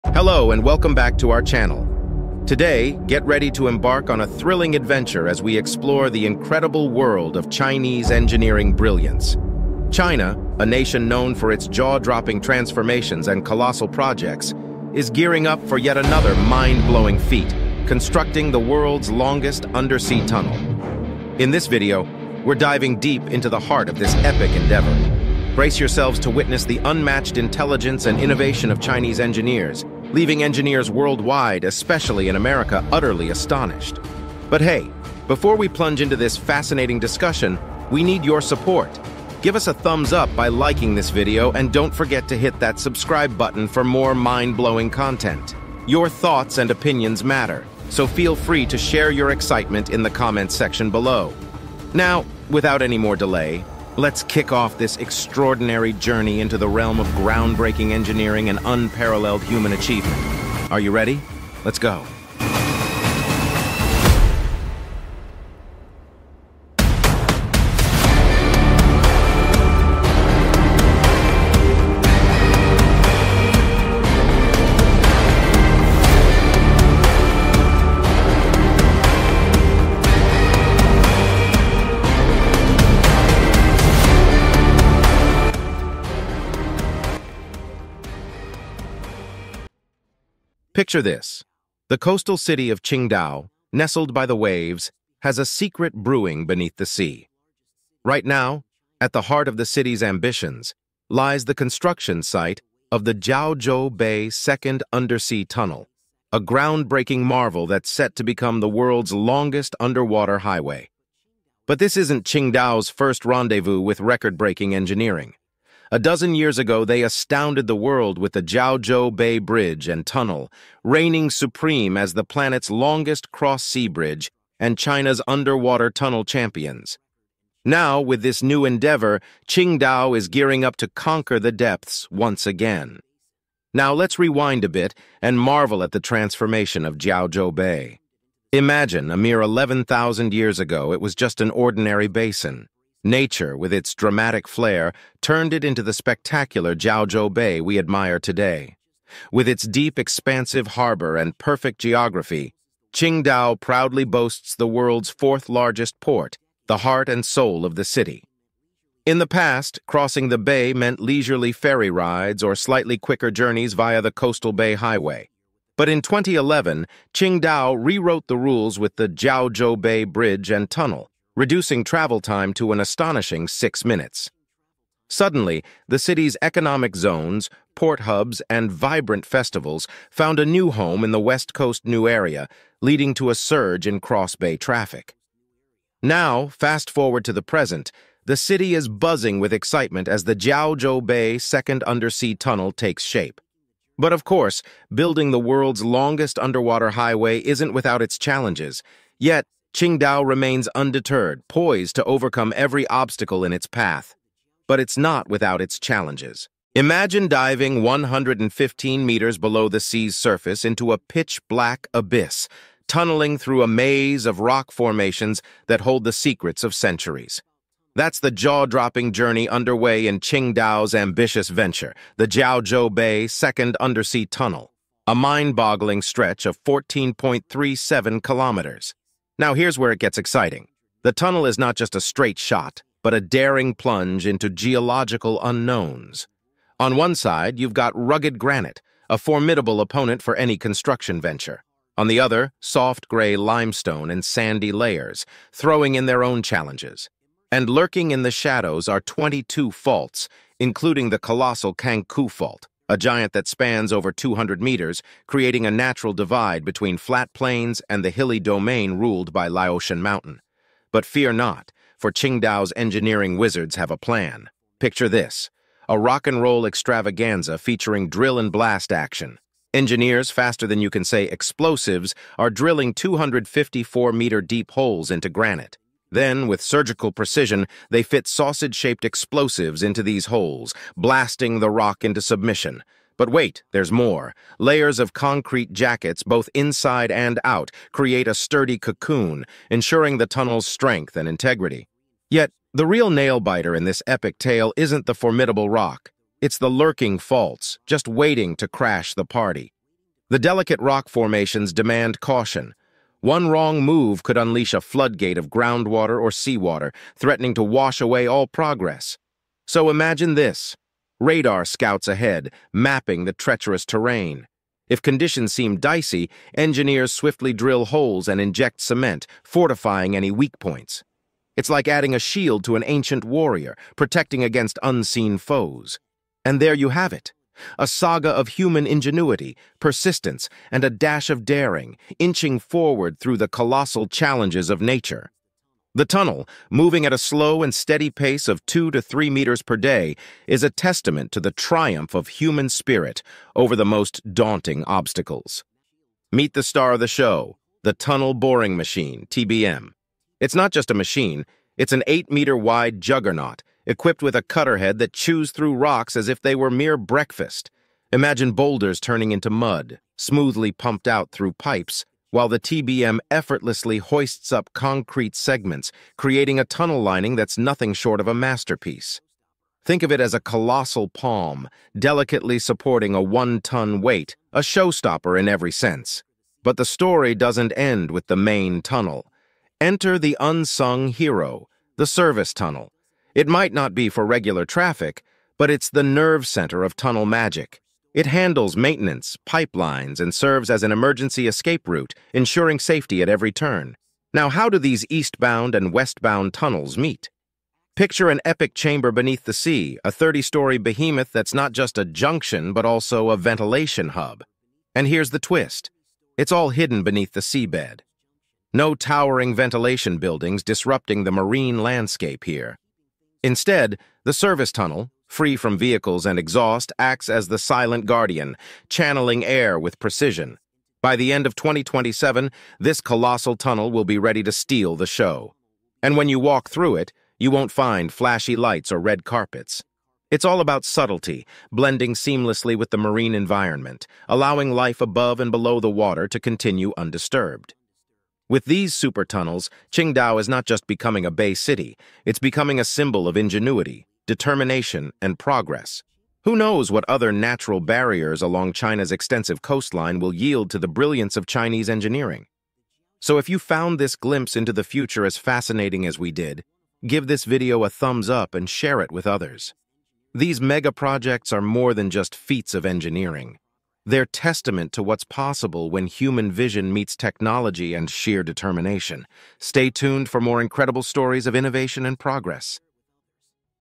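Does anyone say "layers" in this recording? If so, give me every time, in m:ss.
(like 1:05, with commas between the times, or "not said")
4:04, 4:44.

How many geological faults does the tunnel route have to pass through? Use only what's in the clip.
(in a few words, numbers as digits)
22.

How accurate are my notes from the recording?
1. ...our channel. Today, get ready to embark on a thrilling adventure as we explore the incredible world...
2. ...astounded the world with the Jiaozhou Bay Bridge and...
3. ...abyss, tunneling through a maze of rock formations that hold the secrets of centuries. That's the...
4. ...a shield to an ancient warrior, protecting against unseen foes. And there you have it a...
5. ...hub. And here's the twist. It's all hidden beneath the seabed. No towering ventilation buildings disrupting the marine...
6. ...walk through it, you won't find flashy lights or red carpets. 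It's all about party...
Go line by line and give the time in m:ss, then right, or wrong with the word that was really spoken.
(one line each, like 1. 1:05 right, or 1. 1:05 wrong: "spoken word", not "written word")
1. 0:01 right
2. 1:57 right
3. 3:31 right
4. 5:22 right
5. 6:44 right
6. 7:06 wrong: "subtlety", not "party".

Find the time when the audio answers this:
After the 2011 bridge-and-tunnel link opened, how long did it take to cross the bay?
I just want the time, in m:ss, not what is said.
2:53.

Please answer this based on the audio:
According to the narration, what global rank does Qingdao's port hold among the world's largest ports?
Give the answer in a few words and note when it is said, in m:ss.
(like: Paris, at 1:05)
4th, at 2:35.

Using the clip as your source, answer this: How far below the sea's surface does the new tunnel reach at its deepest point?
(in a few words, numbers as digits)
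115 meters.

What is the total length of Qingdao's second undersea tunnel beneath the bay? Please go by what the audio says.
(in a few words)
14.37 kilometers.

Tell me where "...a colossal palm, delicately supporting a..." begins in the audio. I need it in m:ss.
6:10.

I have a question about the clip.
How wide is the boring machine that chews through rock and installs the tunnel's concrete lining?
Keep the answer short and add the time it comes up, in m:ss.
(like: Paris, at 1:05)
8 meters, at 5:52.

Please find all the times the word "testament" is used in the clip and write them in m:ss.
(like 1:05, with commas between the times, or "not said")
5:40, 7:44.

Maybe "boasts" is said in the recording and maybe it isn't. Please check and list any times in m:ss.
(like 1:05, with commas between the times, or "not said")
2:34.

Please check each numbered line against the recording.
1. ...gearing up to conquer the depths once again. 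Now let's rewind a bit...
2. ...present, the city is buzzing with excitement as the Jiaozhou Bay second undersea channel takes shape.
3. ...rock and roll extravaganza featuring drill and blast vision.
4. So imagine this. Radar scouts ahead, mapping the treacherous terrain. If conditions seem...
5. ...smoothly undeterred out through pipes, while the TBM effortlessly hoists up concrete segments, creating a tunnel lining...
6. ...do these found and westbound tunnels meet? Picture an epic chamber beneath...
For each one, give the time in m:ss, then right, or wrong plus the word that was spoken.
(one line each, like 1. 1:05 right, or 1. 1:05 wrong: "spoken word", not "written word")
1. 2:10 right
2. 3:07 wrong: "tunnel", not "channel"
3. 4:25 wrong: "action", not "vision"
4. 5:09 right
5. 6:00 wrong: "pumped", not "undeterred"
6. 6:34 wrong: "eastbound", not "found".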